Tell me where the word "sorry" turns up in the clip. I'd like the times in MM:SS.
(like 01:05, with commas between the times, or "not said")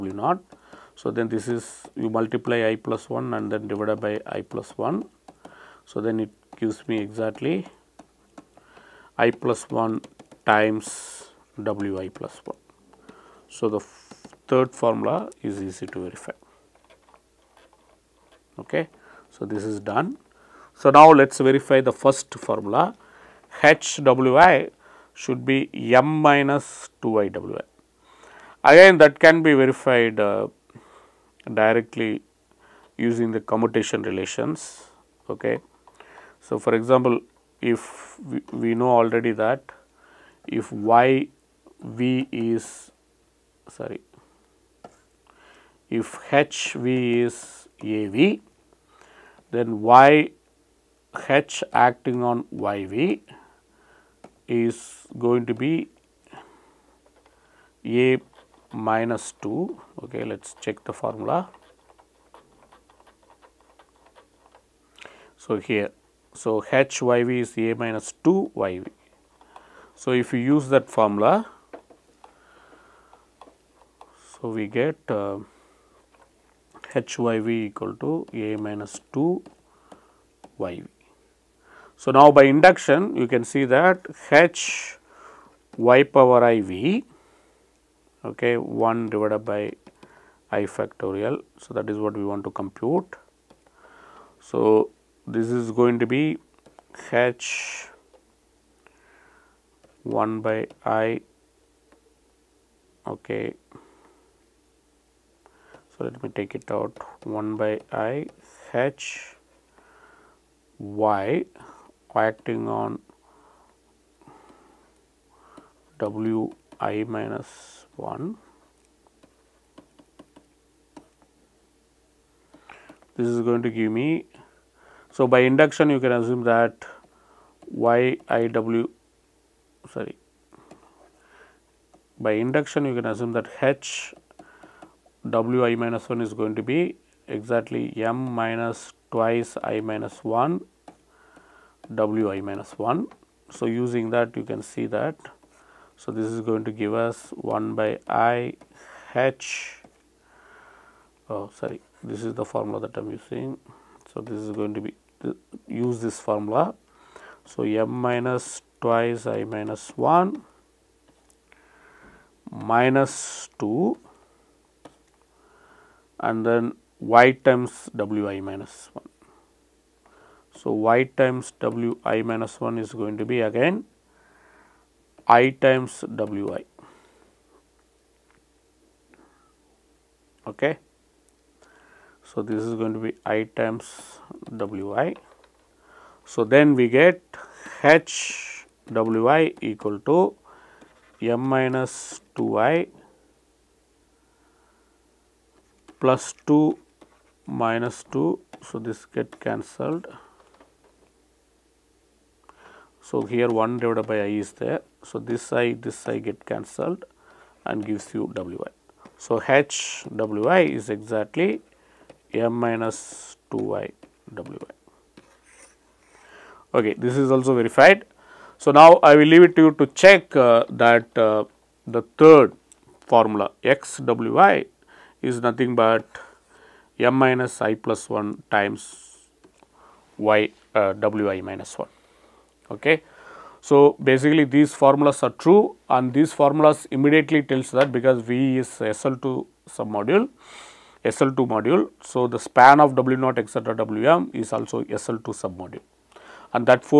00:43, 02:09, 02:31.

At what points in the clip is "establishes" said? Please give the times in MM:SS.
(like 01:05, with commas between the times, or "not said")
not said.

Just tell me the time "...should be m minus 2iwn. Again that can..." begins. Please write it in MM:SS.
00:25.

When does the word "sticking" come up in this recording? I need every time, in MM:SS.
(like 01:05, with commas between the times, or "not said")
not said.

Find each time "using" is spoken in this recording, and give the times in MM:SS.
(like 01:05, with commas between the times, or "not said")
00:33, 02:23, 02:33.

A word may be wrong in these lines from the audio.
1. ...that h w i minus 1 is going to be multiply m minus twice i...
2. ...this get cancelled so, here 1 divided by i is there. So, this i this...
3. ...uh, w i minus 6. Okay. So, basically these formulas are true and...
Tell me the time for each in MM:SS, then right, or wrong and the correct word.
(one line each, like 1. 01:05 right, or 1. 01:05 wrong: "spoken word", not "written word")
1. 02:13 wrong: "exactly", not "multiply"
2. 03:18 right
3. 03:50 wrong: "1", not "6".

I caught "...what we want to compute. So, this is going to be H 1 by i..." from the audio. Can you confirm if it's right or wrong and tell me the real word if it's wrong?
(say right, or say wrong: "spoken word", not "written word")
right.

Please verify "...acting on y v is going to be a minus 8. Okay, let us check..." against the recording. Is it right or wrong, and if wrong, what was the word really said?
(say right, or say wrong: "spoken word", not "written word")
wrong: "2", not "8".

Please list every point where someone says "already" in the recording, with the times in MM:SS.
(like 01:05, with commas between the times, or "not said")
00:39.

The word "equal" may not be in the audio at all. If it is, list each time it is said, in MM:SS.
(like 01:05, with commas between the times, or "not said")
01:17, 03:09.